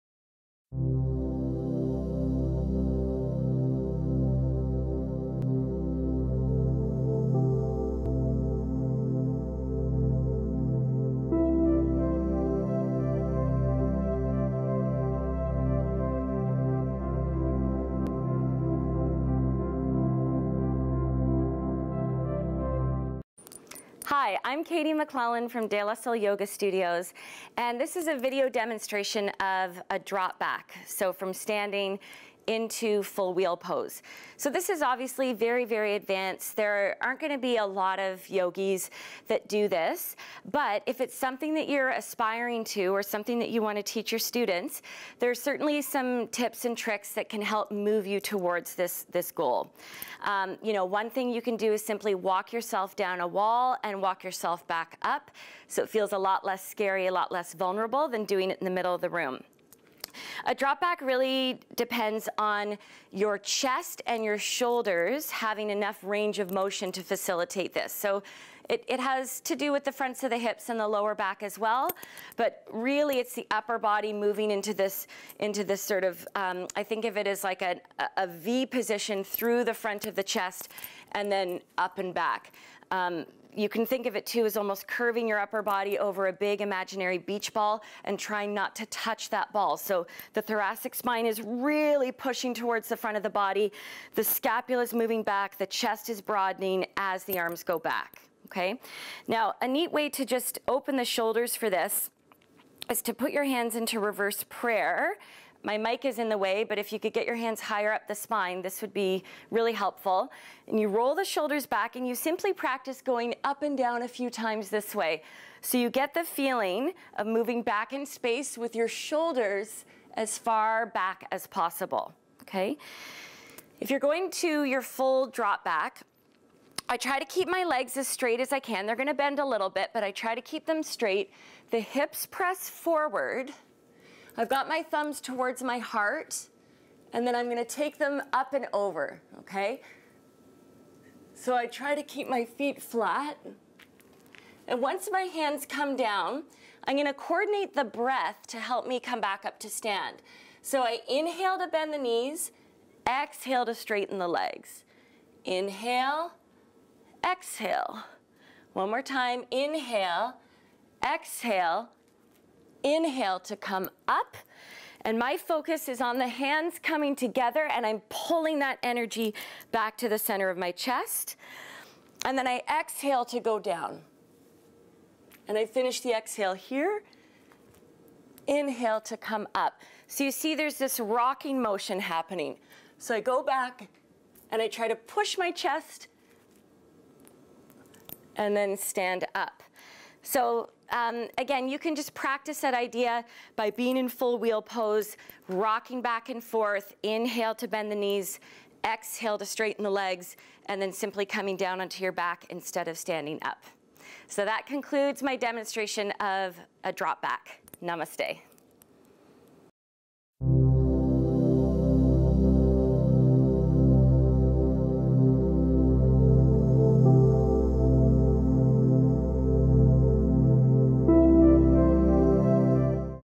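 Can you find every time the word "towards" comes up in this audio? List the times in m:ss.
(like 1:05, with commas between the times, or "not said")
0:48, 1:32, 2:15.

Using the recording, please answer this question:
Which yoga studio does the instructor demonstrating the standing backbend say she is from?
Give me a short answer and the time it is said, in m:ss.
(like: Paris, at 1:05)
De La Sol Yoga Studios, at 0:25.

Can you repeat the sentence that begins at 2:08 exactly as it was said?
They're gonna bend a little bit, but I try to keep them straight.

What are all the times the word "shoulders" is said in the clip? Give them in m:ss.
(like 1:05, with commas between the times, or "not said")
1:04, 1:41, 1:51, 1:58.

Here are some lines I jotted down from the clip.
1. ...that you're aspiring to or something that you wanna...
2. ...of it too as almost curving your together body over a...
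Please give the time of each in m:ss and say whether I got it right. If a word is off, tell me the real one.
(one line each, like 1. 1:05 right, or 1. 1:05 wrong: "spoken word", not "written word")
1. 0:41 right
2. 1:24 wrong: "upper", not "together".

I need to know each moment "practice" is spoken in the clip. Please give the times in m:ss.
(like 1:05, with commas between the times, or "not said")
1:52, 3:12.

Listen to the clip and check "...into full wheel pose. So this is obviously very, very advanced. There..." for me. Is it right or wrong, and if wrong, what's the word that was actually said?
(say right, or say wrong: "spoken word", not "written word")
right.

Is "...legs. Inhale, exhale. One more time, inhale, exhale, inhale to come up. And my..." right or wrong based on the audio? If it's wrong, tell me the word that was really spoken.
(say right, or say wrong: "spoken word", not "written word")
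right.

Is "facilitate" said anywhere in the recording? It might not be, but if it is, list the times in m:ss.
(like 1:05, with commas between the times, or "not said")
1:07.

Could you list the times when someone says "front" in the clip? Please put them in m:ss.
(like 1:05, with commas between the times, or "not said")
1:09, 1:19, 1:32.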